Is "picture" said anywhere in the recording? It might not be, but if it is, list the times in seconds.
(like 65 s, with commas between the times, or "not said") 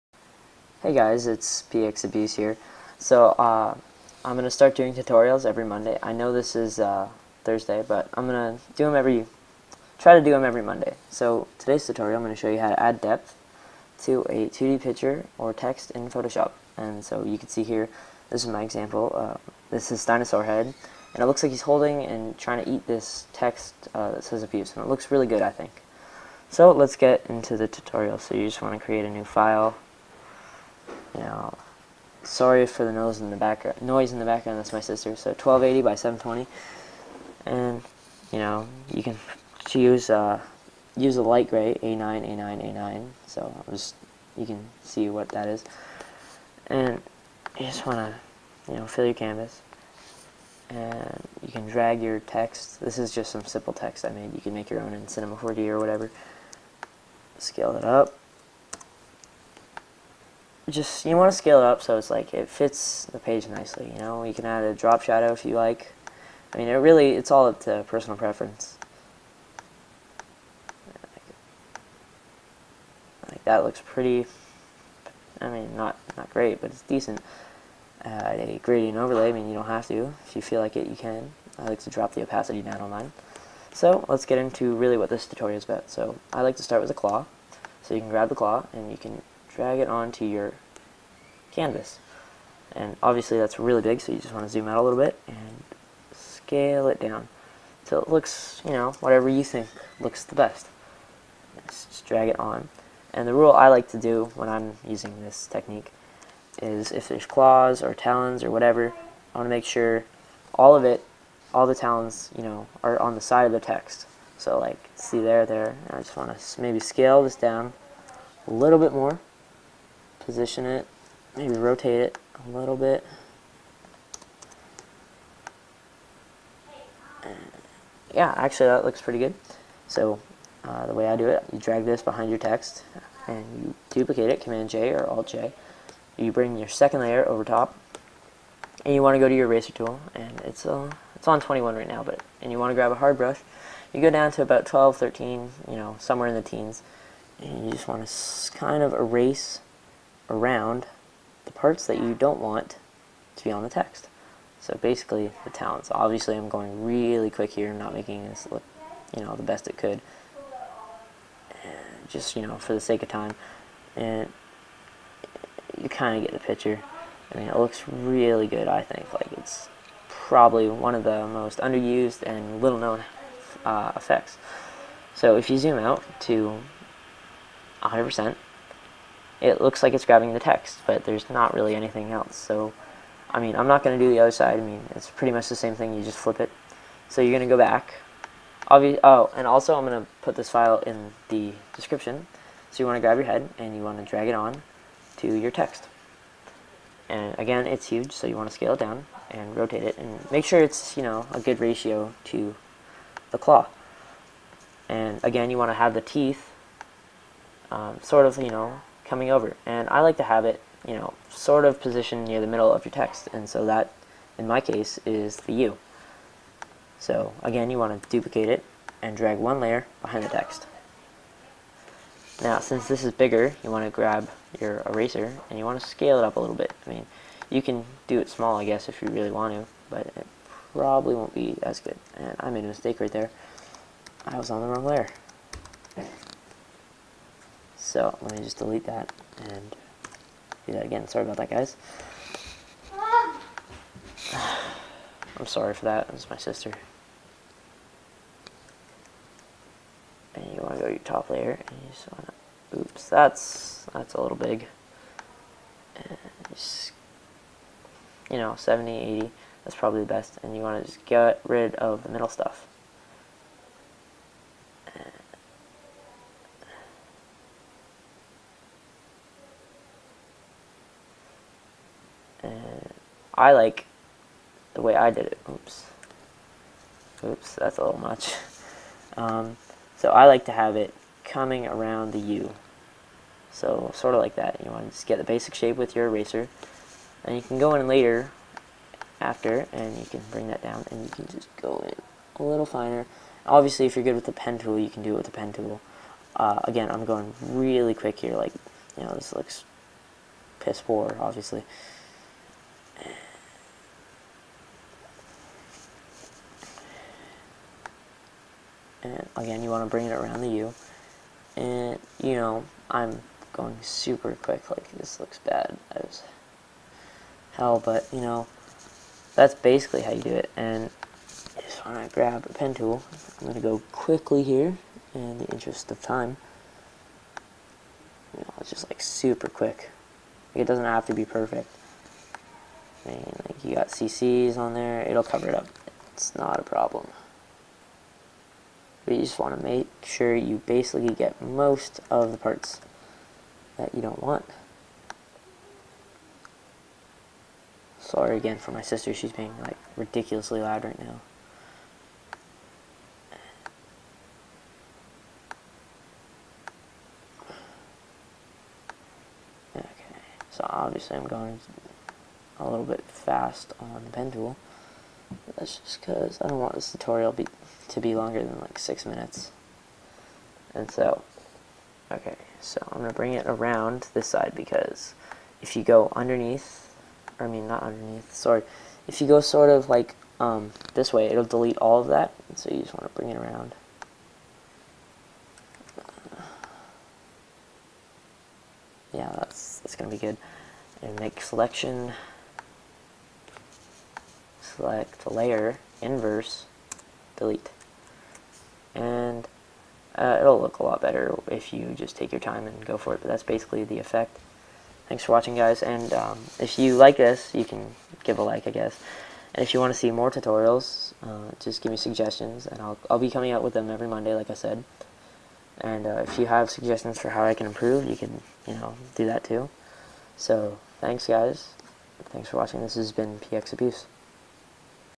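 14 s, 166 s.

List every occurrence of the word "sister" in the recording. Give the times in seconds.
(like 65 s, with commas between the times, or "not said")
34 s, 246 s, 348 s.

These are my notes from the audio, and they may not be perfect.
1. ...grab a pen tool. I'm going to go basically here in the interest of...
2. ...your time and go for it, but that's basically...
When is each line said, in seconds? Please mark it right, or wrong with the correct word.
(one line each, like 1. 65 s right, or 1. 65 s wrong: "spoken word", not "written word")
1. 322 s wrong: "quickly", not "basically"
2. 402 s right.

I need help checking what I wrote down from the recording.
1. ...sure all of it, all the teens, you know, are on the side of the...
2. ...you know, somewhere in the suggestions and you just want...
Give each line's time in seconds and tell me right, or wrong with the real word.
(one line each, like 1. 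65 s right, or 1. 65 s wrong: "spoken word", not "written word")
1. 109 s wrong: "talons", not "teens"
2. 145 s wrong: "teens", not "suggestions".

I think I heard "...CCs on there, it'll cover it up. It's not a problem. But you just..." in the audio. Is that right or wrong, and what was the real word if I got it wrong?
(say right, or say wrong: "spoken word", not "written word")
right.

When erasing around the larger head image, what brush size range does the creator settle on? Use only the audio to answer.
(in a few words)
70 to 80.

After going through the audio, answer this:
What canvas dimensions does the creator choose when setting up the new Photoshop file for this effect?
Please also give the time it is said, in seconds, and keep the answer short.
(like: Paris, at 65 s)
1280 by 720, at 35 s.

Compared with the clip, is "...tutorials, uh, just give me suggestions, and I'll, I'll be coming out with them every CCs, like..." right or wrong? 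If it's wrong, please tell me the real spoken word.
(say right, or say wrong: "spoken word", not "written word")
wrong: "Monday", not "CCs".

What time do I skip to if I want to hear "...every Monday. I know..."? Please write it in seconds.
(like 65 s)
5 s.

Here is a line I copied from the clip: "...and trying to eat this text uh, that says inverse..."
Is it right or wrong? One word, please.
wrong.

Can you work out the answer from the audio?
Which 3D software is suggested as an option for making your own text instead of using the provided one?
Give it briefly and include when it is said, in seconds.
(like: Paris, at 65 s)
Cinema 4D, at 55 s.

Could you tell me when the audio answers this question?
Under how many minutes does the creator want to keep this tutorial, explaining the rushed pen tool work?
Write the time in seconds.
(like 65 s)
368 s.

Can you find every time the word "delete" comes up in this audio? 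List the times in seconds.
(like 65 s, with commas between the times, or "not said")
238 s, 381 s, 397 s.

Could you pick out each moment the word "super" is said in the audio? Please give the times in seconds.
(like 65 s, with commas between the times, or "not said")
313 s, 329 s.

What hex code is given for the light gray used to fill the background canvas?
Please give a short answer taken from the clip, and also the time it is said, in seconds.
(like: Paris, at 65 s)
A9A9A9, at 41 s.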